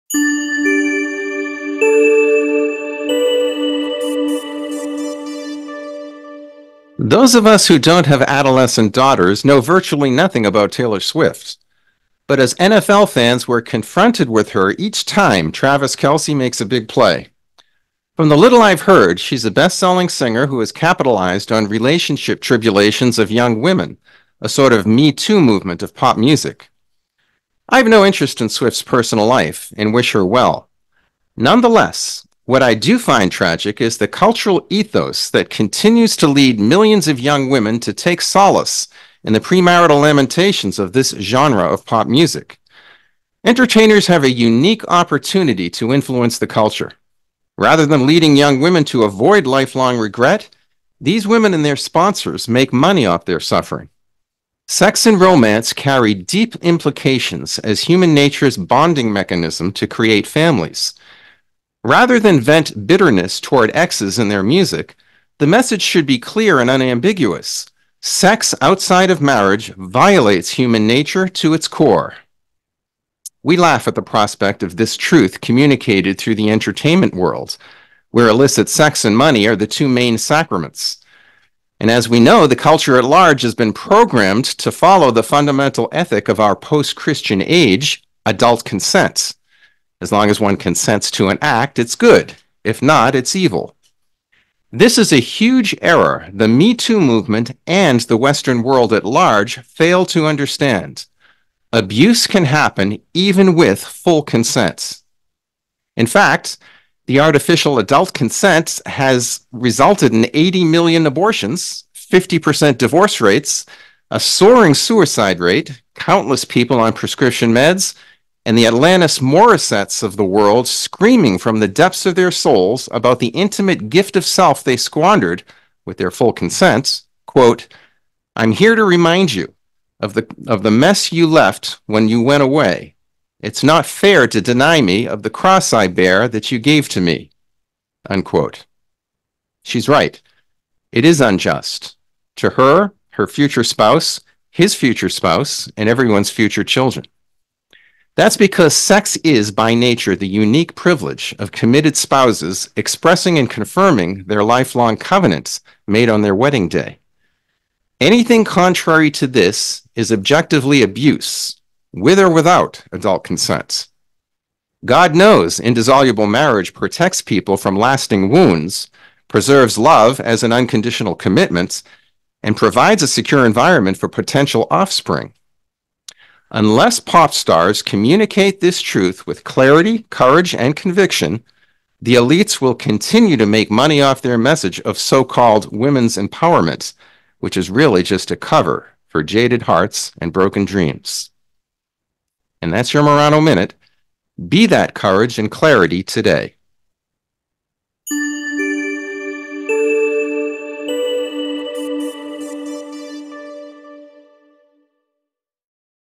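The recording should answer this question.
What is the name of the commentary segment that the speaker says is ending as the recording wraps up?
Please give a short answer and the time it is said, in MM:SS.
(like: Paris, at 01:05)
Murano Minute, at 03:13.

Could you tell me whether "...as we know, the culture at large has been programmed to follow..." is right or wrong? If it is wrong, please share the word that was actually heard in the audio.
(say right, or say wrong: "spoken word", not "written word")
right.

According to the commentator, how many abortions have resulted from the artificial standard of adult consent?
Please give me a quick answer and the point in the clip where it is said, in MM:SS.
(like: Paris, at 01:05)
80 million, at 01:50.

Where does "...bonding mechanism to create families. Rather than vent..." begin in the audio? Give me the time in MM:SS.
00:58.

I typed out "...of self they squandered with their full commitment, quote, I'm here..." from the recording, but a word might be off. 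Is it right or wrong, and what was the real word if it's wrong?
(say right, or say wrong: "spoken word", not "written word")
wrong: "consent", not "commitment".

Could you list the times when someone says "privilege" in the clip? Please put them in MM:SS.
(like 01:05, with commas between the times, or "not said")
02:30.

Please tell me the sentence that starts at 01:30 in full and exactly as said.
As long as one consents to an act, it's good.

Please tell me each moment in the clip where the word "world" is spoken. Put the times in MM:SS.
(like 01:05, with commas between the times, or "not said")
01:17, 01:38, 02:00.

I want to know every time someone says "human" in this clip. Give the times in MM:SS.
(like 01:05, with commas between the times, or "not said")
00:57, 01:10.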